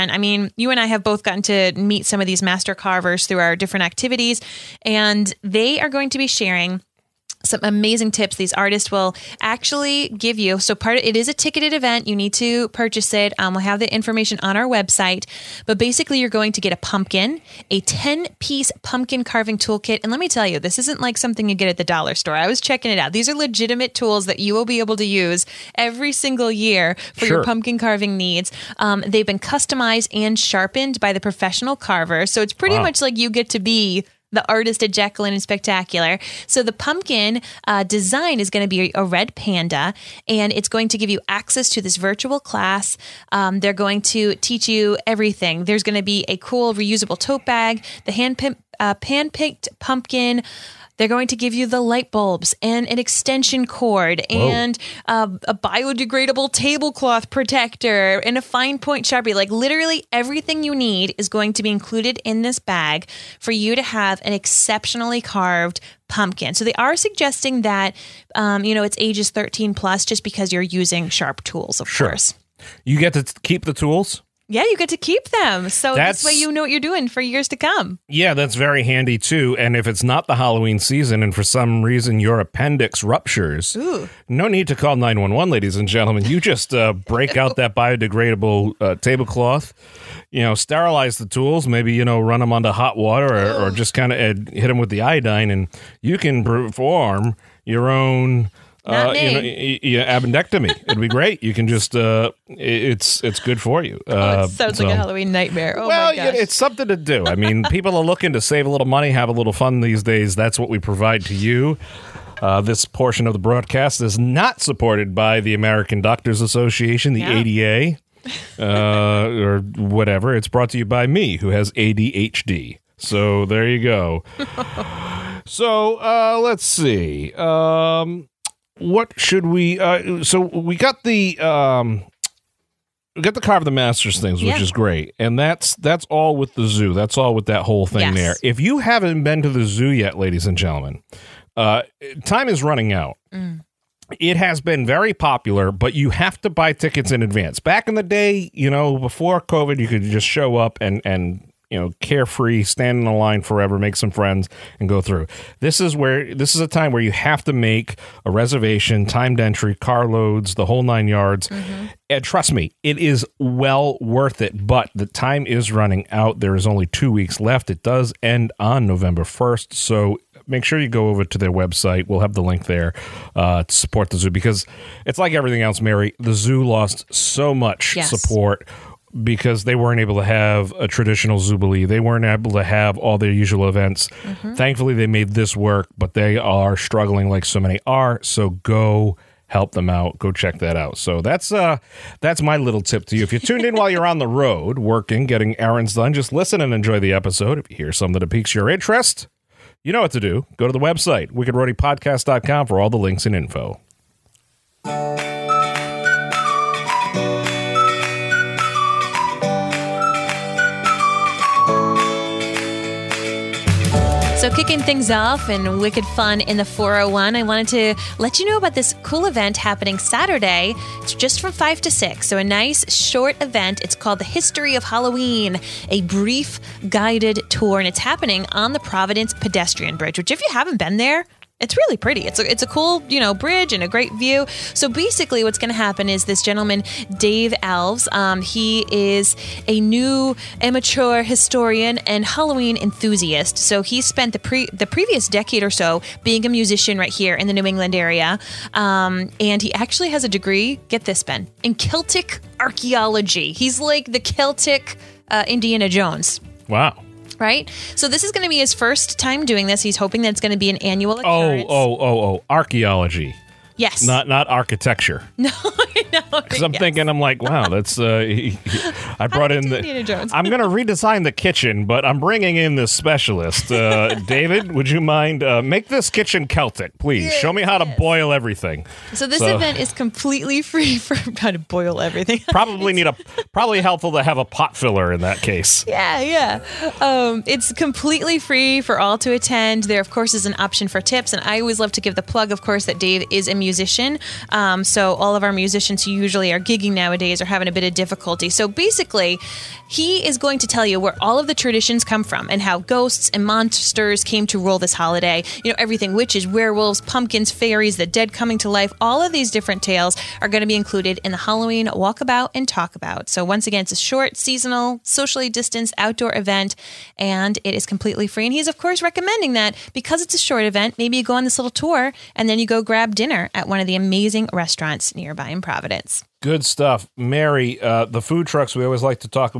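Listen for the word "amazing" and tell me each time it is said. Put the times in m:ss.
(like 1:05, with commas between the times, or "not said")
0:07, 5:23.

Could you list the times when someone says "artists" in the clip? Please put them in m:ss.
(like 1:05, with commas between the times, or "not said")
0:08, 0:34.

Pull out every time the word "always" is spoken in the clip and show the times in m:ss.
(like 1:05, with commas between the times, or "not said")
4:51, 5:28.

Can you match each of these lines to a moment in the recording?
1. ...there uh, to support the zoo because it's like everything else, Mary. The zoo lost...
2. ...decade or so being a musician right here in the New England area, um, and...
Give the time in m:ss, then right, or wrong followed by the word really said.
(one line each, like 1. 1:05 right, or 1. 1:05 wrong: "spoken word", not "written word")
1. 2:52 right
2. 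4:05 right.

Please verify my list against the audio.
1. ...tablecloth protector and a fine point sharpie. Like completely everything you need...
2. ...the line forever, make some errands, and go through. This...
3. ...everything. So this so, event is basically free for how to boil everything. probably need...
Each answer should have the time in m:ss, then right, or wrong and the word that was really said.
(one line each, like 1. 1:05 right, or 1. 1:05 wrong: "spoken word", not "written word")
1. 0:56 wrong: "literally", not "completely"
2. 2:33 wrong: "friends", not "errands"
3. 4:38 wrong: "completely", not "basically".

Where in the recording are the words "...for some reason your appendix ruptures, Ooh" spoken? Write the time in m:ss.
1:21.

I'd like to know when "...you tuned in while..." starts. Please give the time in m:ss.
3:13.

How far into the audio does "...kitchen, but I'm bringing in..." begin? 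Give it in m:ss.
4:31.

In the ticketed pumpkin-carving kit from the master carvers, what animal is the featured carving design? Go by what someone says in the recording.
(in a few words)
Red panda.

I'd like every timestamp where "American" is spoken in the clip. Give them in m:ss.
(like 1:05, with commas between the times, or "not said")
1:55.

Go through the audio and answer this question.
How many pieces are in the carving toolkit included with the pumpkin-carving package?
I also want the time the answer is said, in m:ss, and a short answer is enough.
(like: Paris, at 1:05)
10, at 0:17.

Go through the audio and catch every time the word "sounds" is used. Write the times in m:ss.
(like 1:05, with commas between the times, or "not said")
1:44.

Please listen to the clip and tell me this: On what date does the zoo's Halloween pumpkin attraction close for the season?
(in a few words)
November 1.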